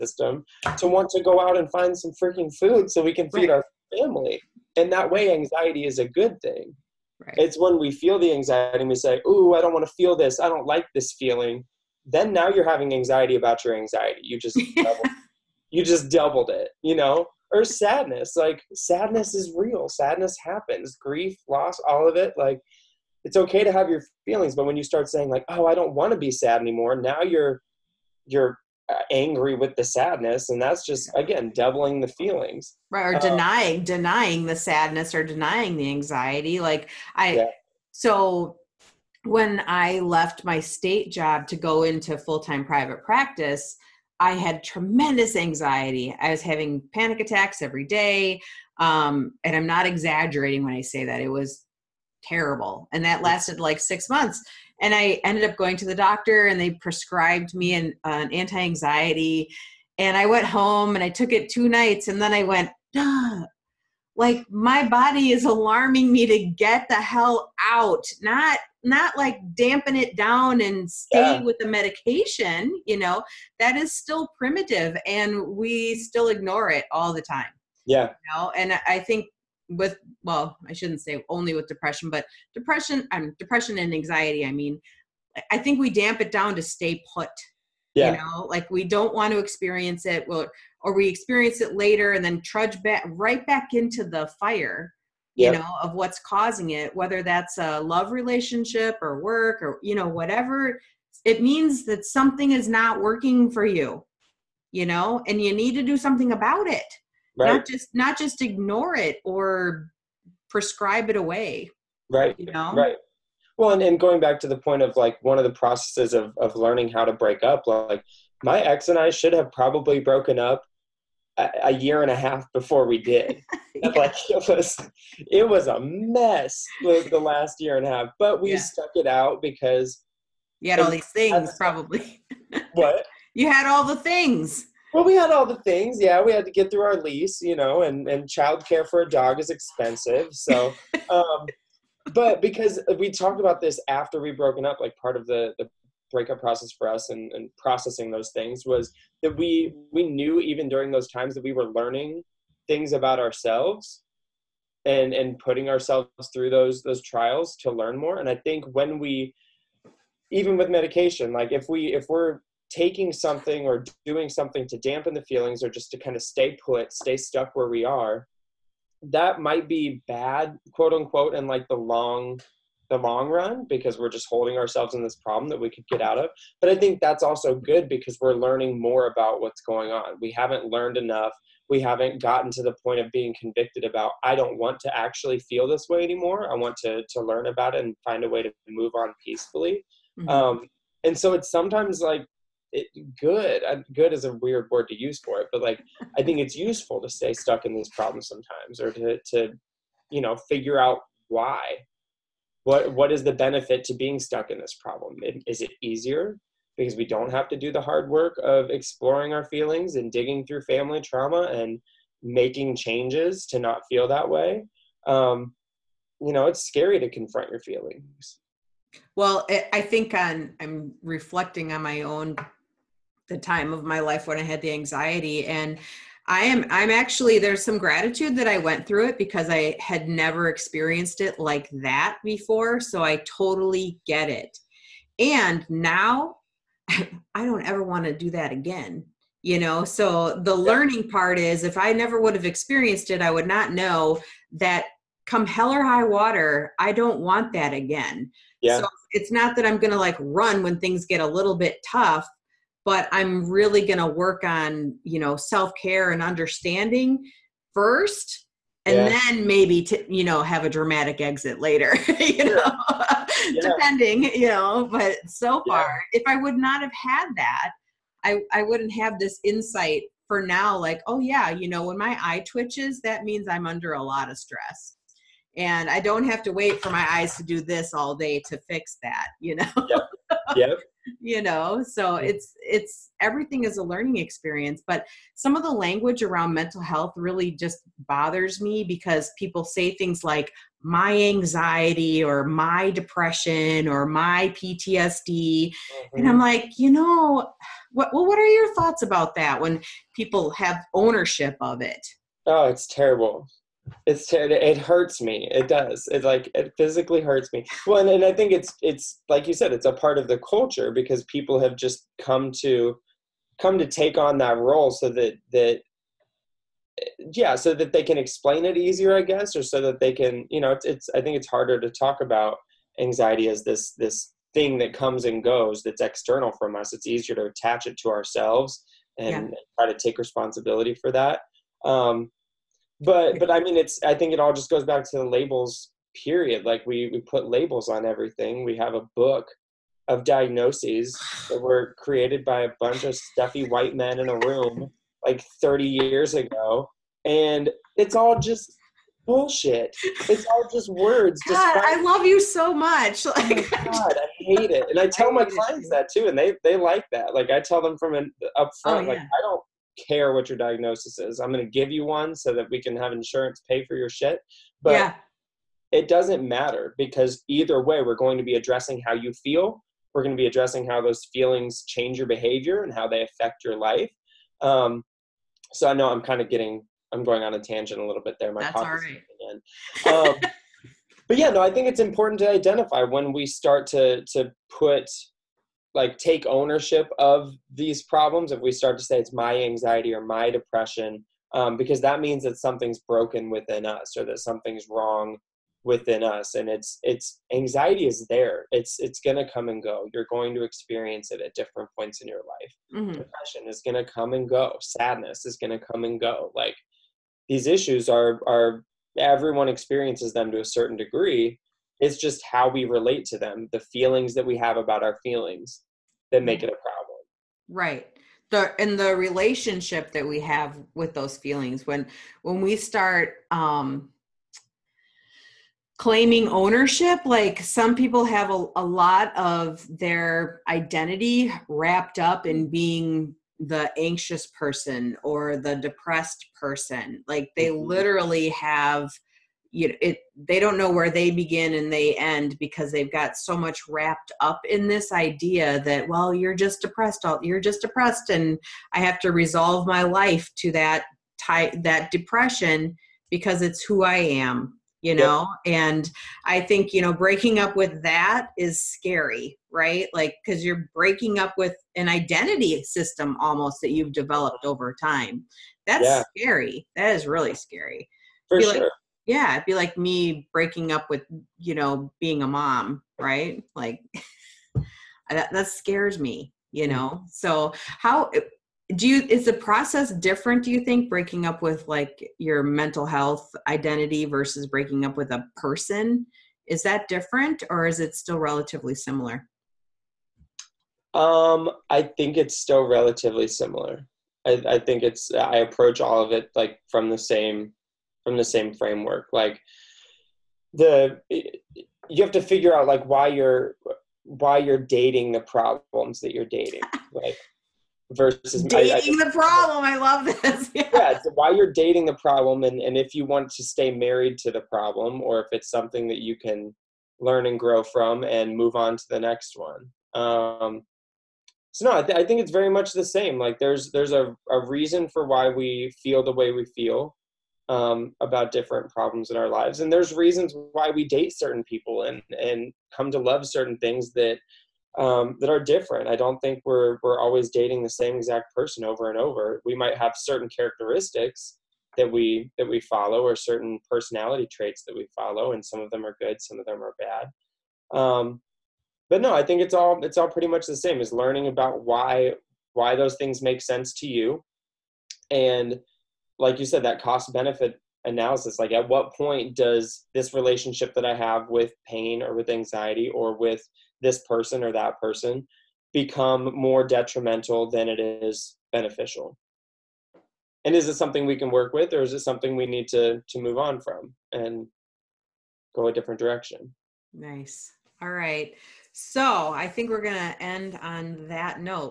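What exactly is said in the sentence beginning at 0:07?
It's when we feel the anxiety and we say, Ooh, I don't want to feel this.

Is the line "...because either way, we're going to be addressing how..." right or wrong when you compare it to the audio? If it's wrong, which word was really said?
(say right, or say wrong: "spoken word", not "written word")
right.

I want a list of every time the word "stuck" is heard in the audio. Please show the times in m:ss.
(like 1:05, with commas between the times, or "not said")
2:08, 2:47, 3:17, 3:24.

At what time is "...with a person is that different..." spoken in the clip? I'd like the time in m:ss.
8:05.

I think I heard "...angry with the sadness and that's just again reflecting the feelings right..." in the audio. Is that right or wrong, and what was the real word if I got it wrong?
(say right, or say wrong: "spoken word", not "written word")
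wrong: "doubling", not "reflecting".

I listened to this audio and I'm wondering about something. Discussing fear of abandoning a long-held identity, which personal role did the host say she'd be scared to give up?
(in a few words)
being a mom.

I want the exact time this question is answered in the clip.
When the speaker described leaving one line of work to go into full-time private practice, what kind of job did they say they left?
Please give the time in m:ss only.
0:40.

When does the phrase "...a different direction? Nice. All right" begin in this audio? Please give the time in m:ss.
9:35.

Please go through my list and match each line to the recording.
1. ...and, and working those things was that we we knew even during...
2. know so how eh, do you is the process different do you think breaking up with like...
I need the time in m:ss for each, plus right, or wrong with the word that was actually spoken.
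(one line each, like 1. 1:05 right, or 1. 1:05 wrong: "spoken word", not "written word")
1. 2:27 wrong: "processing", not "working"
2. 7:56 right.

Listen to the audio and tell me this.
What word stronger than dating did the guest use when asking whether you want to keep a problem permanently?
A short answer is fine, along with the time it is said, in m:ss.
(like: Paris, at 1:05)
married, at 8:33.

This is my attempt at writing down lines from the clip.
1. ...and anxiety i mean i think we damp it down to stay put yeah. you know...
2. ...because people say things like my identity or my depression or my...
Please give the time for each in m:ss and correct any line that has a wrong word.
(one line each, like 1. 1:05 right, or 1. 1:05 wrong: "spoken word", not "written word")
1. 1:23 right
2. 4:48 wrong: "anxiety", not "identity".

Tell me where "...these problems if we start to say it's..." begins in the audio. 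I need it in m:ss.
6:27.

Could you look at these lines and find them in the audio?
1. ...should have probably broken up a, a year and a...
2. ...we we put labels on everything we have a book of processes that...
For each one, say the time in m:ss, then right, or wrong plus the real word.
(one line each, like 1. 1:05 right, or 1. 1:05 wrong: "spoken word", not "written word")
1. 1:59 right
2. 5:36 wrong: "diagnoses", not "processes".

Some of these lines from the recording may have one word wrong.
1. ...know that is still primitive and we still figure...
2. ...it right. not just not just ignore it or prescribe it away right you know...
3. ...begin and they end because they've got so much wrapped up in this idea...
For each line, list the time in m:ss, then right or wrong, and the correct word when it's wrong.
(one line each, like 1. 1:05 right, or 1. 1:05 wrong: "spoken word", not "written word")
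1. 1:12 wrong: "ignore", not "figure"
2. 1:46 right
3. 7:21 right.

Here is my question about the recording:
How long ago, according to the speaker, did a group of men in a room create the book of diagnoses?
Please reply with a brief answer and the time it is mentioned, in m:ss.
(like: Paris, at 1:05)
30 years ago, at 5:45.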